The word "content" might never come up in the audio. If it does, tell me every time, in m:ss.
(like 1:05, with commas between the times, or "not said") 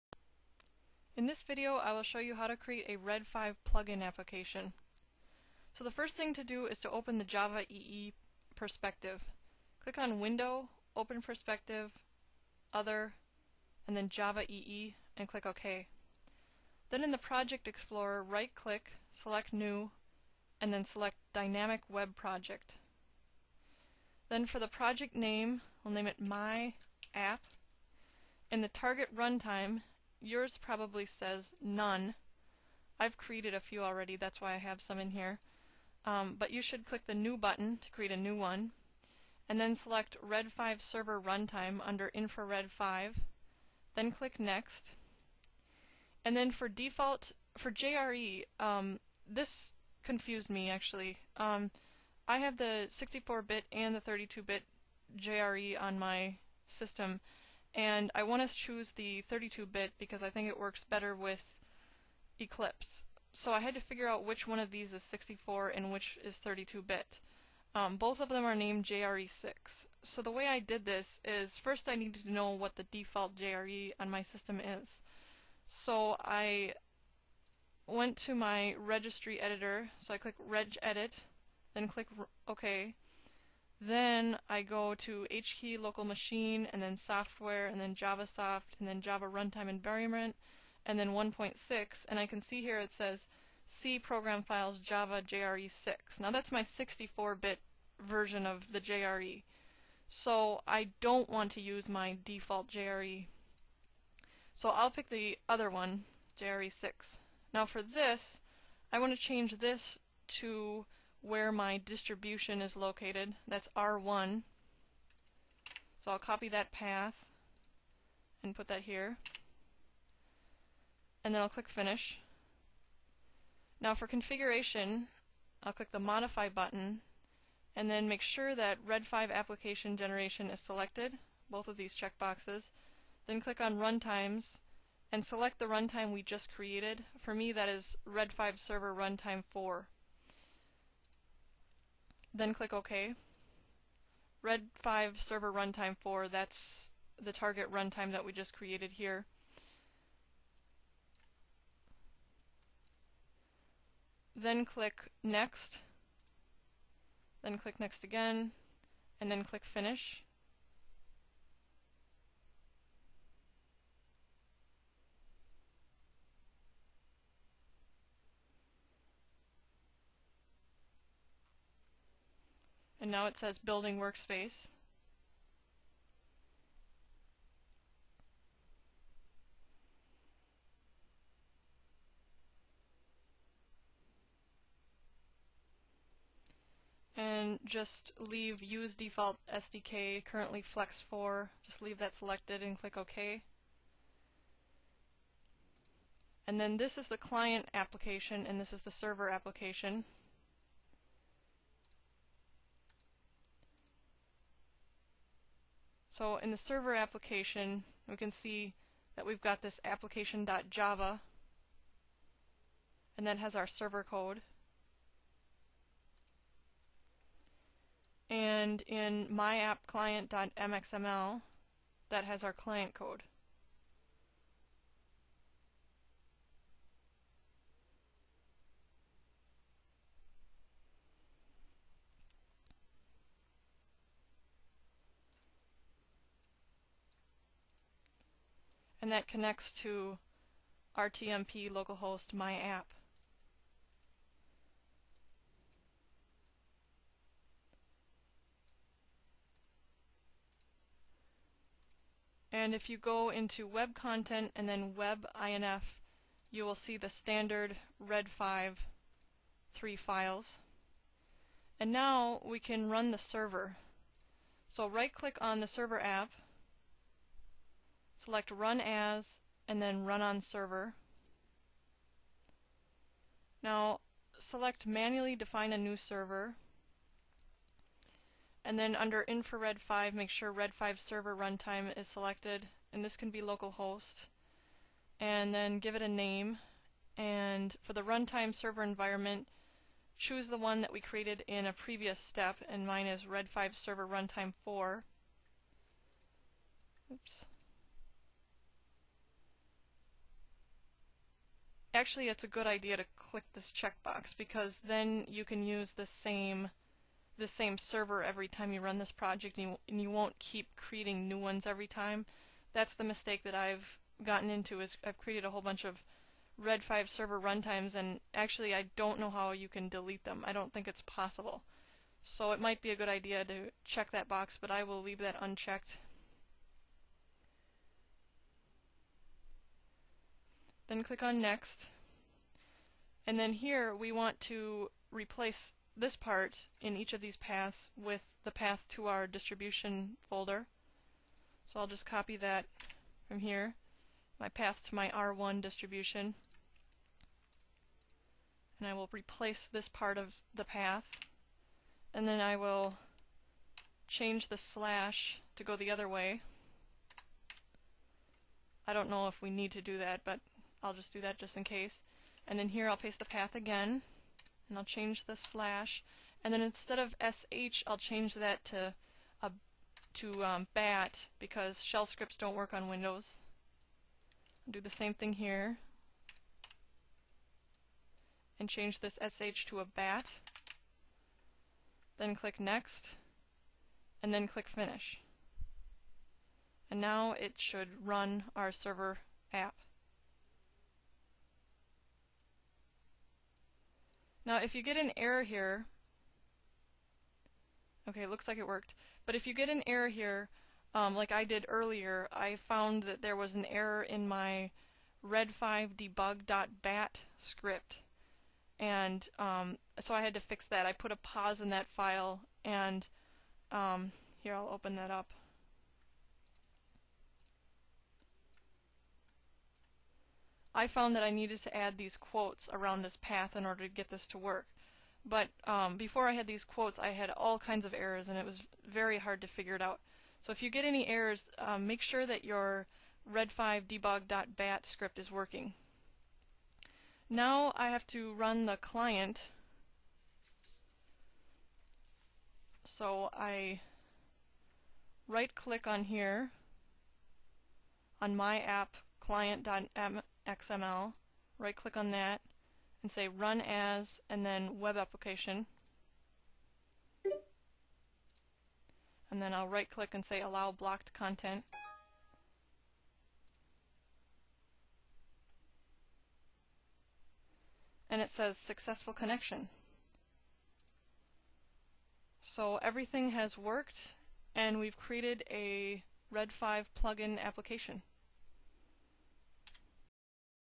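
4:13, 7:41.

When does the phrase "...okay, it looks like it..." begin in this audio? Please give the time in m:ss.
6:38.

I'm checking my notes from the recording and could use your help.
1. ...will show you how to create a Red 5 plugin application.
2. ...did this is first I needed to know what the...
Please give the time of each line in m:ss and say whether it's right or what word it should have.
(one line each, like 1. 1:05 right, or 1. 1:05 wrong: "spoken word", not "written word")
1. 0:01 right
2. 1:10 right.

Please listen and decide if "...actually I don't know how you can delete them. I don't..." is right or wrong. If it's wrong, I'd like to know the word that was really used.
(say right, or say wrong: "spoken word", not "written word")
right.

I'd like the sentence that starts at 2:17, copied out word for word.
For me that is Red 5 Server Runtime 4 then click OK.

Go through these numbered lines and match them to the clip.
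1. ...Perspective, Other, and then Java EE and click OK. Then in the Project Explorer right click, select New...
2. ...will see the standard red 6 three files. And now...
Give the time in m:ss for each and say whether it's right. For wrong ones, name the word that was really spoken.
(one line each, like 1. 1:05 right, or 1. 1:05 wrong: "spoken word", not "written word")
1. 0:11 right
2. 4:16 wrong: "5", not "6".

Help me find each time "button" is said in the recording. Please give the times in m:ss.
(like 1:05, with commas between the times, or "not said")
0:37, 2:06.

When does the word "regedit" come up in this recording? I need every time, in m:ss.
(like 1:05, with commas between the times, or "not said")
1:20.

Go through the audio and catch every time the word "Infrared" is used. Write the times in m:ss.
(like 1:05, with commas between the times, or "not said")
0:42, 4:39.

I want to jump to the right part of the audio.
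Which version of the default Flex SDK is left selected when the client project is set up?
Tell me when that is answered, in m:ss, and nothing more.
3:10.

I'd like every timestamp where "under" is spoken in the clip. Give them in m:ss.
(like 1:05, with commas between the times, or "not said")
0:41, 4:38.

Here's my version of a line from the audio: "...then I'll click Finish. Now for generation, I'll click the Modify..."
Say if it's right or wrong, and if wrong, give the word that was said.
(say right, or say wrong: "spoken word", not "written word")
wrong: "configuration", not "generation".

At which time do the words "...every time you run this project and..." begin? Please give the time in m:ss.
5:08.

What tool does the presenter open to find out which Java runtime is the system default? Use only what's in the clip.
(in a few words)
registry editor.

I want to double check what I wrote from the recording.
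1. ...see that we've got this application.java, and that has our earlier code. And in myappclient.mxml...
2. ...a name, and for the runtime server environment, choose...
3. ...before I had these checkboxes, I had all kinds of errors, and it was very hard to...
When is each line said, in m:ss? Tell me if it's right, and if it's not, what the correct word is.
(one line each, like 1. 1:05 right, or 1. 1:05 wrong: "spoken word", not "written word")
1. 3:28 wrong: "server", not "earlier"
2. 4:46 right
3. 7:05 wrong: "quotes", not "checkboxes".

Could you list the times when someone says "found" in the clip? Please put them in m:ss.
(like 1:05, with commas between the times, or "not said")
6:42, 7:00.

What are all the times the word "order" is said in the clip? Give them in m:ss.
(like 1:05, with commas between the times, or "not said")
7:03.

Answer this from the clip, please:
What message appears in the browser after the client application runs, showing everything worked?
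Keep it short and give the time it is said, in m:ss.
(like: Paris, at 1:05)
Successful Connection, at 7:48.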